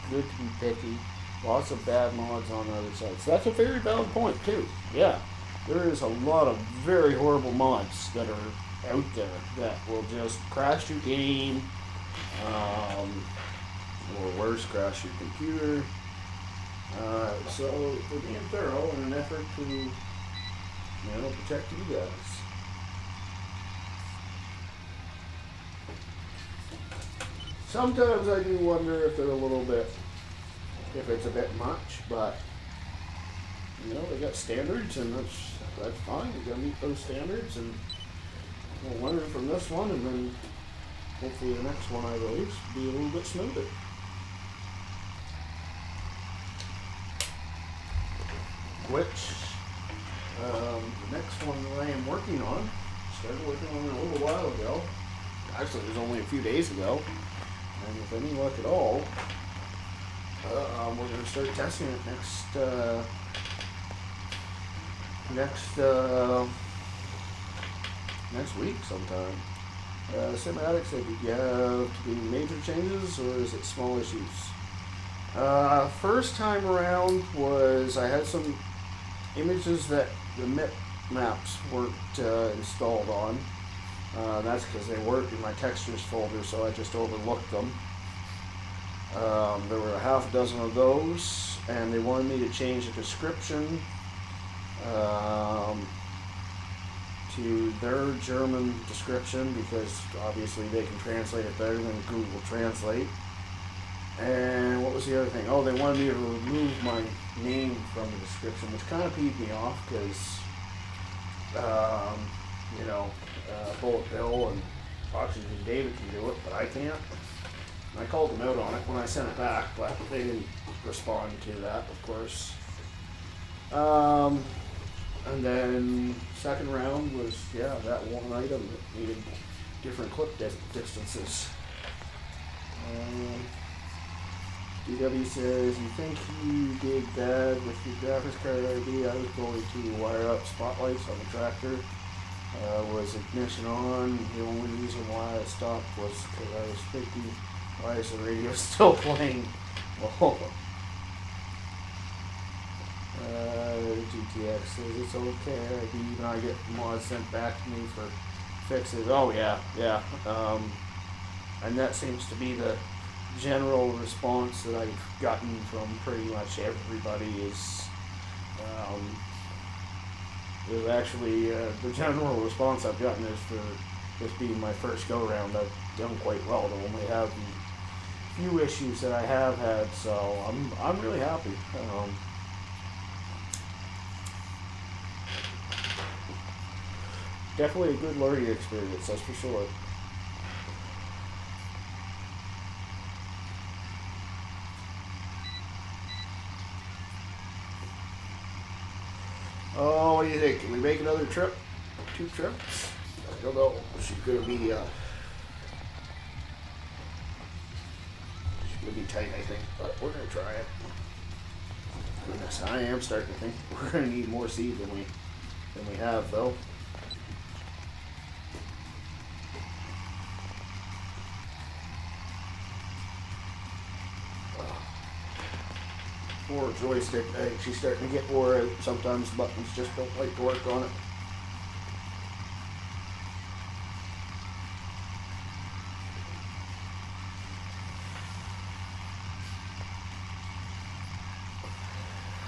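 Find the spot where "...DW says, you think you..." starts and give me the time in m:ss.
2:14.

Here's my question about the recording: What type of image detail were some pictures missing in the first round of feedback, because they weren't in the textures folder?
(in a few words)
MIP maps.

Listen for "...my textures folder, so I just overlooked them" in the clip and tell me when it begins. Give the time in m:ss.
1:25.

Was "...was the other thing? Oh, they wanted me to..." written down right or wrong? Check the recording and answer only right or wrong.
right.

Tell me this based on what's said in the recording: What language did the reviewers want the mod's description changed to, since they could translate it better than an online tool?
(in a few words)
German.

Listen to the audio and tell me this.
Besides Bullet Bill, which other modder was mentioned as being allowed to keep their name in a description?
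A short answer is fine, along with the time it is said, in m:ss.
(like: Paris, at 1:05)
Oxygen David, at 1:55.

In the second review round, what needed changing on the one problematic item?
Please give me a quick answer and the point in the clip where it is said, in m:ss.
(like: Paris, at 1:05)
clip distances, at 2:10.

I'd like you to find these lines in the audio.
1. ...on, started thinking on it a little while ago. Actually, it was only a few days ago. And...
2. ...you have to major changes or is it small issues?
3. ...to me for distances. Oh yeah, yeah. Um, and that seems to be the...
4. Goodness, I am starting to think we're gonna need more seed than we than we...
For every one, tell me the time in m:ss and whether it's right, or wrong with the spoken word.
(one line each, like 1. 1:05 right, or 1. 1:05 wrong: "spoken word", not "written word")
1. 0:52 wrong: "working", not "thinking"
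2. 1:11 right
3. 2:37 wrong: "fixes", not "distances"
4. 3:32 right.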